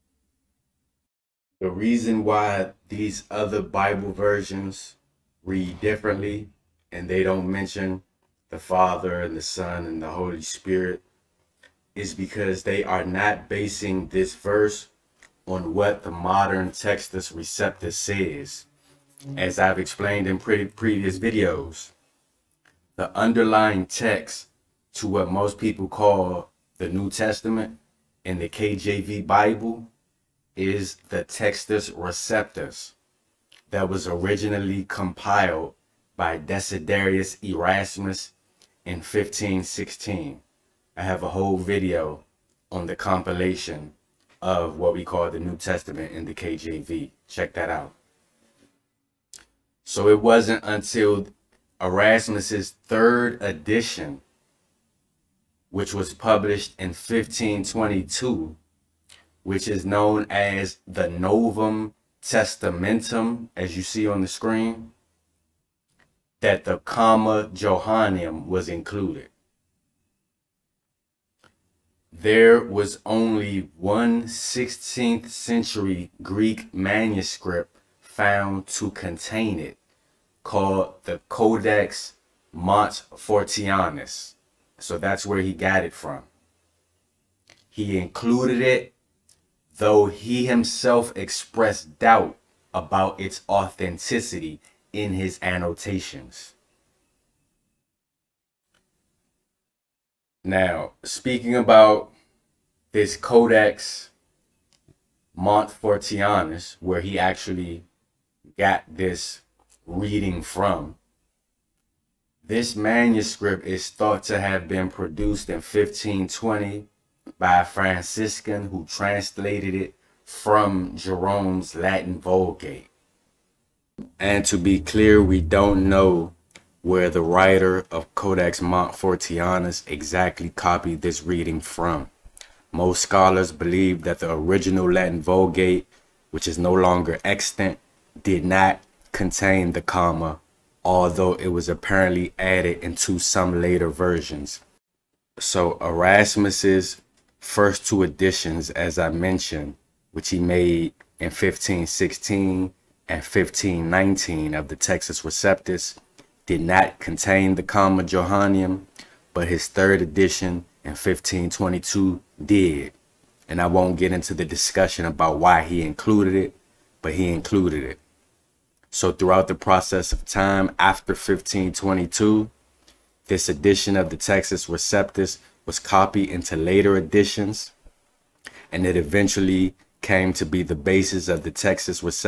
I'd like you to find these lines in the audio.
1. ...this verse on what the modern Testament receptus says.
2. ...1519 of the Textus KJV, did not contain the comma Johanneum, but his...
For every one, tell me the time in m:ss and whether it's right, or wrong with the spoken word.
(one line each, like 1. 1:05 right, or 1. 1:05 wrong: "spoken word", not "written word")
1. 0:14 wrong: "Textus", not "Testament"
2. 2:33 wrong: "Receptus", not "KJV".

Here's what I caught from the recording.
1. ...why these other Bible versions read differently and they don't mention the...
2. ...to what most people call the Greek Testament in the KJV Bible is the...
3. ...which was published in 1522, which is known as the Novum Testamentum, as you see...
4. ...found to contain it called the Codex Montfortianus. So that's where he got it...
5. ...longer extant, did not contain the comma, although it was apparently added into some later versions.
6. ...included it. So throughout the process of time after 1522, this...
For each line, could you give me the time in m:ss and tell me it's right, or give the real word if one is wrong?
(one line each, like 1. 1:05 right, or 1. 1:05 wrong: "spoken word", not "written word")
1. 0:02 right
2. 0:24 wrong: "New", not "Greek"
3. 0:55 right
4. 1:17 right
5. 2:16 right
6. 2:47 right.